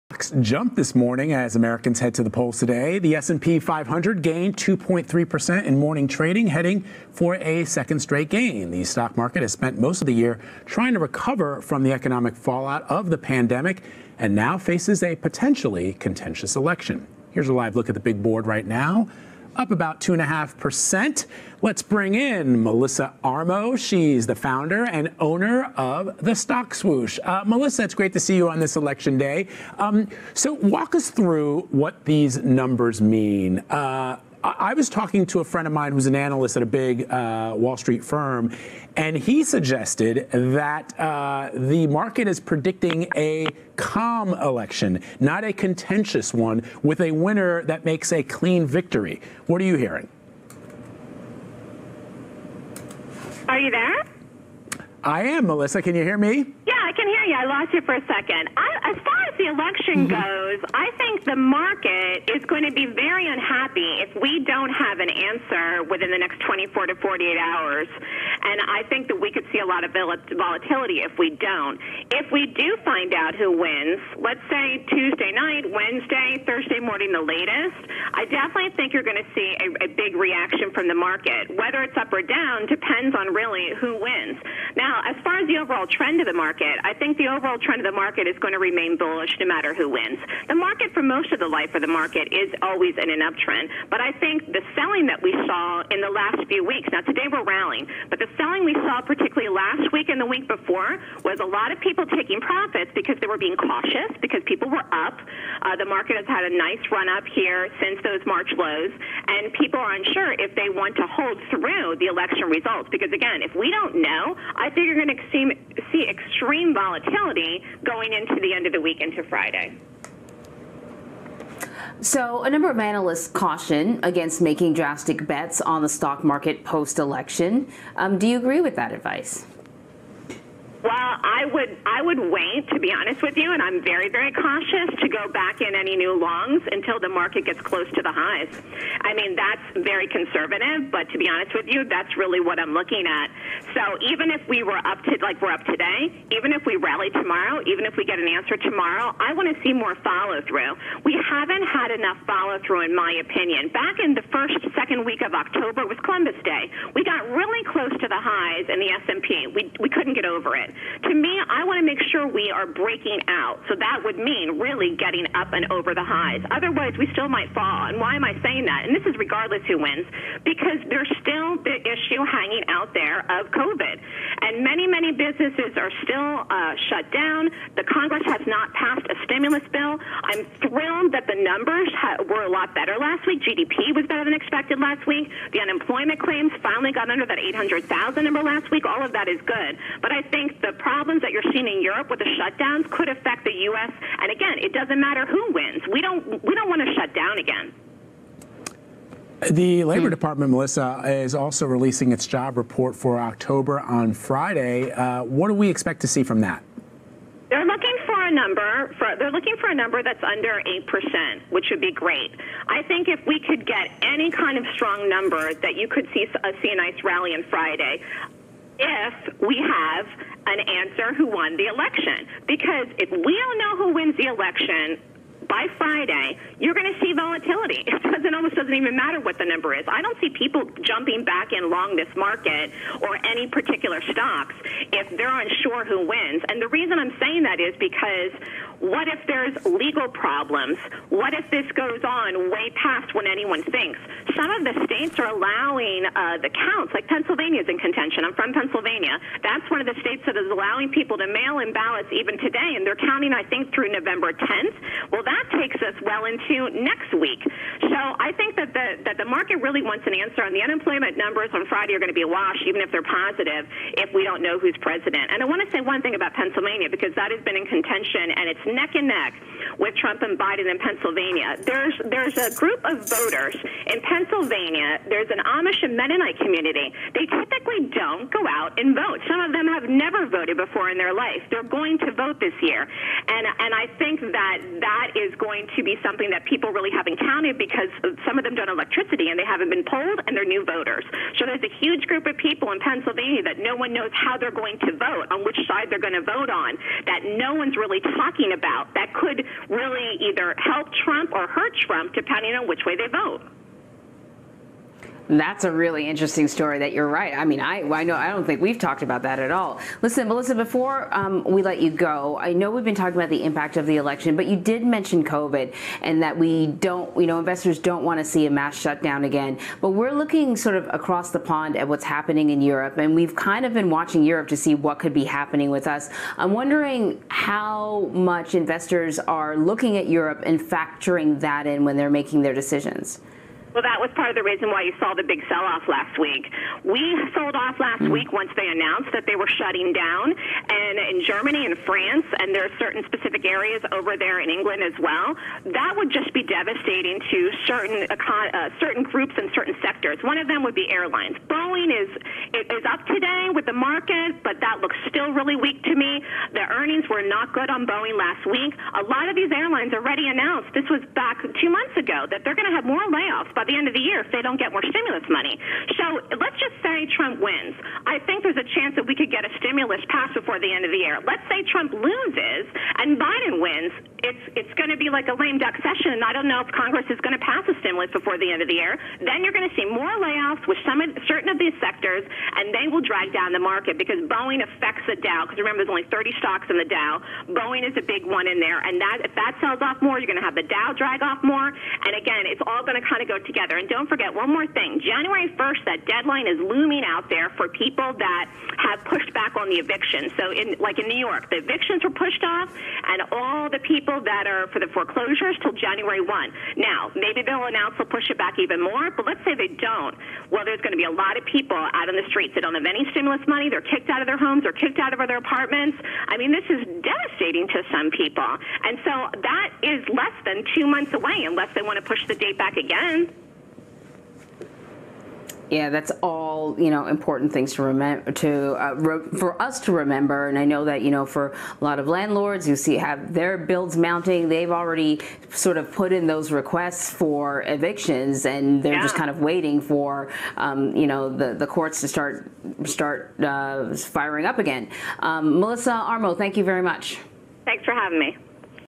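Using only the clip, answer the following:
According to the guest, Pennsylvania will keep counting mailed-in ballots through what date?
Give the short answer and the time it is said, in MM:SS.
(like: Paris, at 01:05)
November 10, at 04:13.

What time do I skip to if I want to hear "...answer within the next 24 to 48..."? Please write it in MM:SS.
01:05.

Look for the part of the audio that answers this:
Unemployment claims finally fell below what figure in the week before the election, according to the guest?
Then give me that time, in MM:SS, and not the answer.
03:07.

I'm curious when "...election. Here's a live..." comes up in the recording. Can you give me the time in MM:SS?
00:16.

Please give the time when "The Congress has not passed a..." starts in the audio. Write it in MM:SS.
02:57.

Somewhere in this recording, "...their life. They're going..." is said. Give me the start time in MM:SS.
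04:40.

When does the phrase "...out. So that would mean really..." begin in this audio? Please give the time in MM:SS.
02:43.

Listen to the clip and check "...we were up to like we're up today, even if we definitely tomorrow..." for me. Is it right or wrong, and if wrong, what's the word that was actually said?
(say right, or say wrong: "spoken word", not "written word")
wrong: "rally", not "definitely".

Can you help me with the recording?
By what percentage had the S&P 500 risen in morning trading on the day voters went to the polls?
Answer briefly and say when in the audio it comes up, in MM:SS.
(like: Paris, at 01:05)
2.3%, at 00:04.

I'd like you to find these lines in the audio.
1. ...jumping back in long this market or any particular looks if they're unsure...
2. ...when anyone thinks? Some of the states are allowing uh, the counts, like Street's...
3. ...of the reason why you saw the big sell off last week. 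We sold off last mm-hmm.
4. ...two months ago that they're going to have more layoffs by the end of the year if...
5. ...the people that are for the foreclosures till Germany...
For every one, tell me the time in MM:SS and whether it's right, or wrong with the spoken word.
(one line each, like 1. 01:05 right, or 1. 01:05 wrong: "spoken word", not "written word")
1. 03:50 wrong: "stocks", not "looks"
2. 04:03 wrong: "Pennsylvania", not "Street"
3. 05:34 right
4. 06:01 right
5. 06:43 wrong: "January", not "Germany".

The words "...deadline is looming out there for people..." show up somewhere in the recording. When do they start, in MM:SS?
06:36.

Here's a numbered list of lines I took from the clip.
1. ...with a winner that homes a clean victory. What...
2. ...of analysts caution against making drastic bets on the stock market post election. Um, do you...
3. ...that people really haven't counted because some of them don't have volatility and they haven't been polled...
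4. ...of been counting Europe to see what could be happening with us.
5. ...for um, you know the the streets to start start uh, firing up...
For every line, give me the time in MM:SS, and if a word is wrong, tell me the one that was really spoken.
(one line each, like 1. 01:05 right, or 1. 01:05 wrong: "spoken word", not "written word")
1. 00:46 wrong: "makes", not "homes"
2. 02:02 right
3. 04:46 wrong: "electricity", not "volatility"
4. 05:23 wrong: "watching", not "counting"
5. 07:19 wrong: "courts", not "streets".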